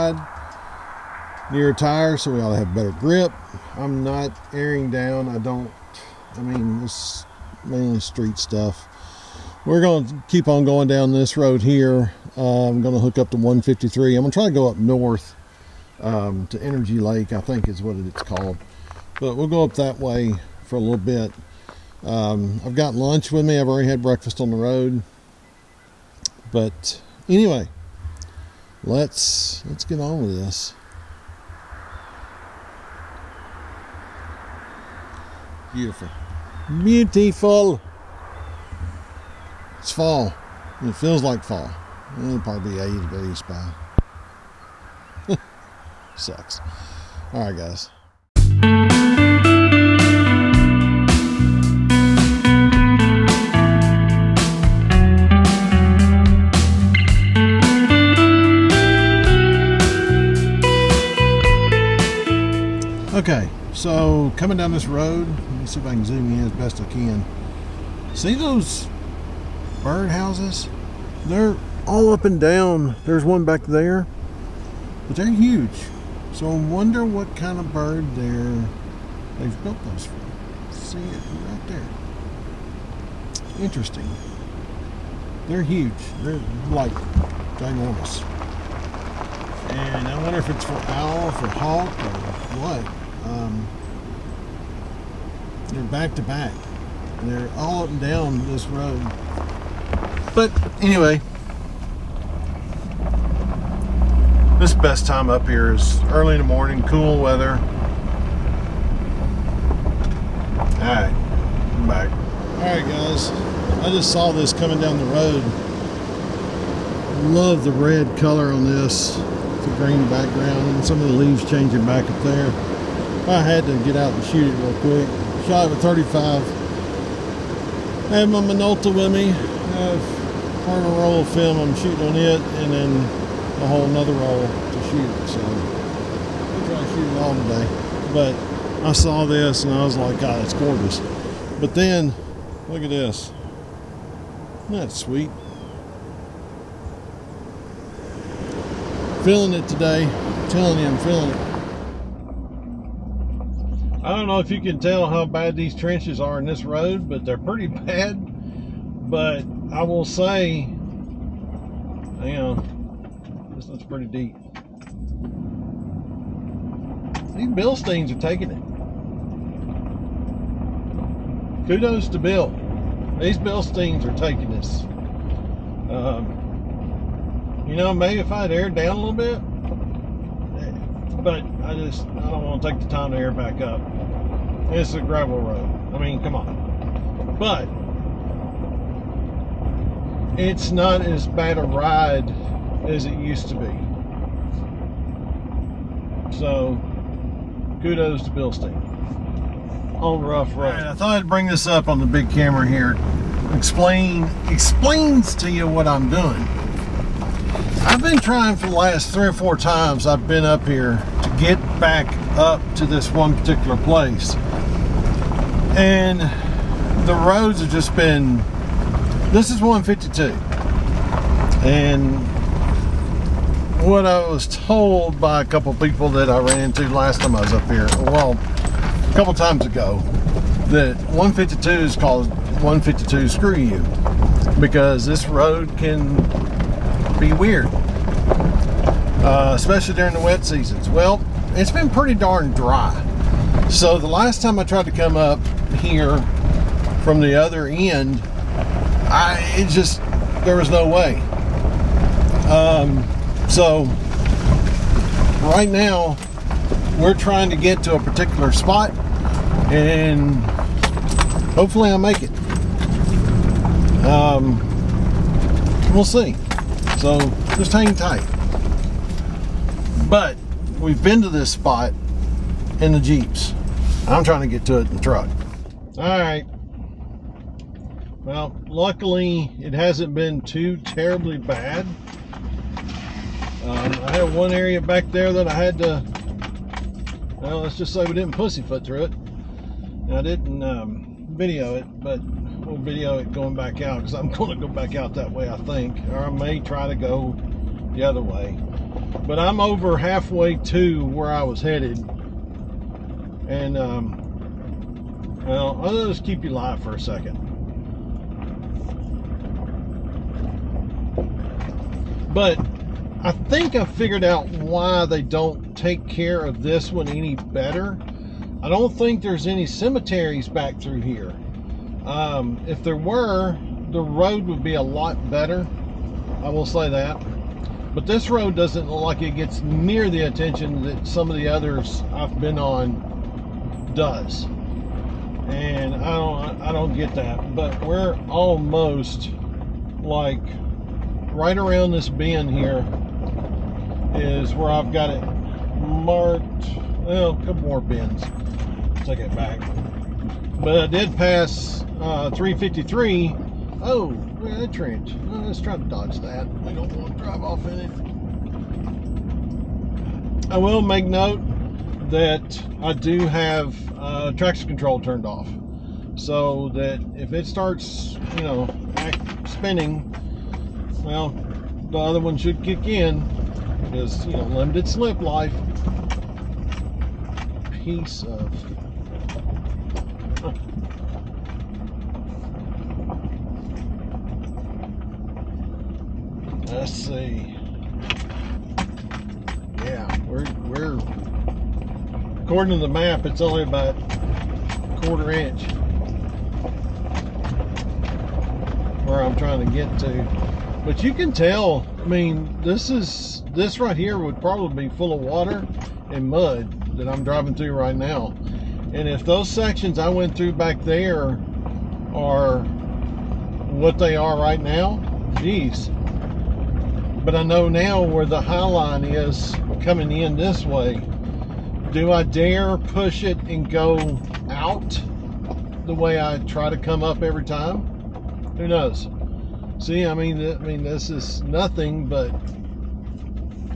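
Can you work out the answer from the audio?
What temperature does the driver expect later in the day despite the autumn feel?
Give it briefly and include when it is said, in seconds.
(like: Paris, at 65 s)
80 degrees, at 42 s.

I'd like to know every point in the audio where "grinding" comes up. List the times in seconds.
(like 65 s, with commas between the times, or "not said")
not said.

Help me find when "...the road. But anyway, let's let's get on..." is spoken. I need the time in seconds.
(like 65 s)
24 s.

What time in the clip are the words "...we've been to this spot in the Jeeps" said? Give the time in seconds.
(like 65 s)
270 s.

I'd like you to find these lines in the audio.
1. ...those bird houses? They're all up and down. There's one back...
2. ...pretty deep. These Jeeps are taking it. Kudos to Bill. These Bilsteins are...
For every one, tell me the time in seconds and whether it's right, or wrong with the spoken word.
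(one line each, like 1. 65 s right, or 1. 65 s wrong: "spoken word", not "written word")
1. 68 s right
2. 163 s wrong: "Bilsteins", not "Jeeps".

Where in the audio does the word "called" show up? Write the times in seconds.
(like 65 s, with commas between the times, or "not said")
18 s, 231 s.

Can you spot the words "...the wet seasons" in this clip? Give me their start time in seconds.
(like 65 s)
240 s.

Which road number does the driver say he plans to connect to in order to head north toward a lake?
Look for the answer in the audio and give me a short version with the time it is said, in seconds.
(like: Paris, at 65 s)
153, at 13 s.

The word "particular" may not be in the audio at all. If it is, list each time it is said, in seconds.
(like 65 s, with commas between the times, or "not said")
213 s, 257 s.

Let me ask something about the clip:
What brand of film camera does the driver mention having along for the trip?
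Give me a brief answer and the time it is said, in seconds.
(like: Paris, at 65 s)
Minolta, at 128 s.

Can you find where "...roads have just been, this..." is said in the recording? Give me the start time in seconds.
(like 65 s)
217 s.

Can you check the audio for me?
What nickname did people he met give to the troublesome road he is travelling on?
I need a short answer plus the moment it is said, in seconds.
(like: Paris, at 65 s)
152 Screw You, at 232 s.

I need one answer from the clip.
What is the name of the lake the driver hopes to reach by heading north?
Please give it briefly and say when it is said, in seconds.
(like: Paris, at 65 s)
Energy Lake, at 16 s.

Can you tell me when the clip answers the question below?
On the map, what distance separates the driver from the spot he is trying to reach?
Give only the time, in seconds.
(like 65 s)
395 s.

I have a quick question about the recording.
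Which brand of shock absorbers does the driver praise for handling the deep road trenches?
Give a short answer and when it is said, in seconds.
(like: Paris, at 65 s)
Bilstein, at 198 s.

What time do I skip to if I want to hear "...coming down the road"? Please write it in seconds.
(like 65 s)
114 s.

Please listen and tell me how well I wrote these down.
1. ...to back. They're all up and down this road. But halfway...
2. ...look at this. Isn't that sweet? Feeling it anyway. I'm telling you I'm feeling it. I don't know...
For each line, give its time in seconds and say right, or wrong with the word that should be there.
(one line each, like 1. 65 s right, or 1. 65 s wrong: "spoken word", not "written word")
1. 96 s wrong: "anyway", not "halfway"
2. 142 s wrong: "today", not "anyway".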